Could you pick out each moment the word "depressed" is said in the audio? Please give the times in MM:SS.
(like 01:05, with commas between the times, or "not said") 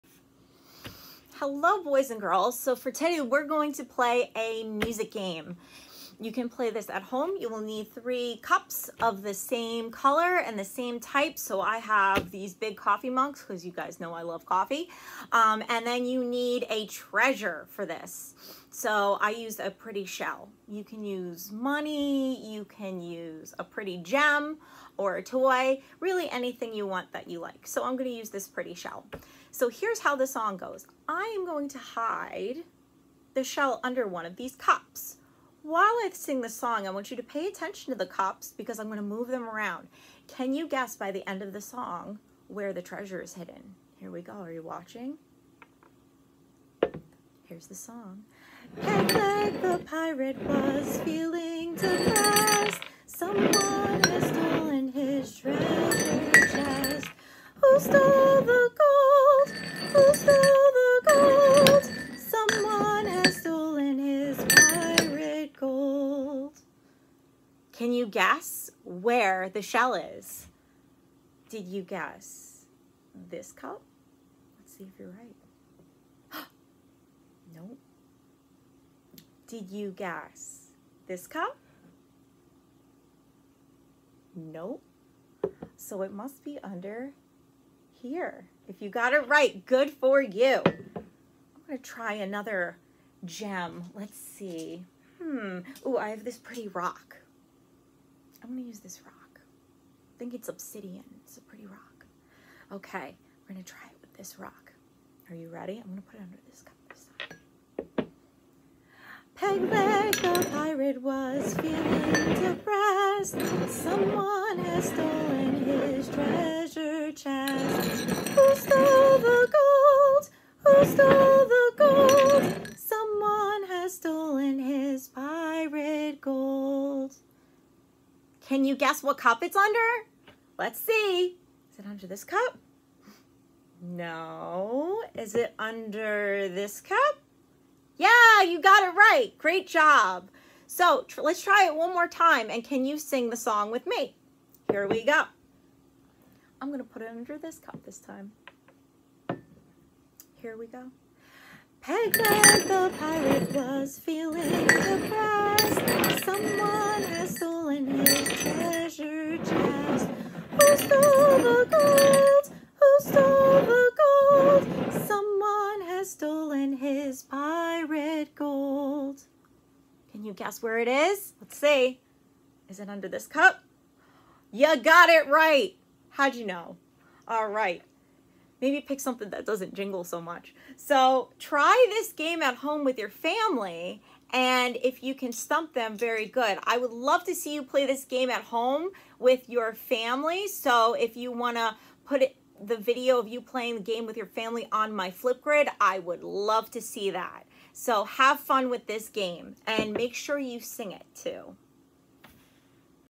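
00:51, 01:52.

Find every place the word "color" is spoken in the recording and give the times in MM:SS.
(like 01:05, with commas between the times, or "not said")
00:09.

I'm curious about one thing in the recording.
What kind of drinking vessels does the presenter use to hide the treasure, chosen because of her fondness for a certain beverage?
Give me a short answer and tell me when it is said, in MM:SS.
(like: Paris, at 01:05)
Coffee mugs, at 00:12.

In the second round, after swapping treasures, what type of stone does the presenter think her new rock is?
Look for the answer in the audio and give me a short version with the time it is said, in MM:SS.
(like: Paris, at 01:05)
Obsidian, at 01:40.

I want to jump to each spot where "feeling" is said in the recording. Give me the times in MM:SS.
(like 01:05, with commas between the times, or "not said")
00:51, 01:51, 02:33.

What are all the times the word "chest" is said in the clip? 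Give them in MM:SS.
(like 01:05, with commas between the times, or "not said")
00:56, 01:57.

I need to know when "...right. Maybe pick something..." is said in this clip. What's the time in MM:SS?
02:57.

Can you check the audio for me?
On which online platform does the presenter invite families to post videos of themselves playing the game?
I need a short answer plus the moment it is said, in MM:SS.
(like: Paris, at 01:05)
Flipgrid, at 03:15.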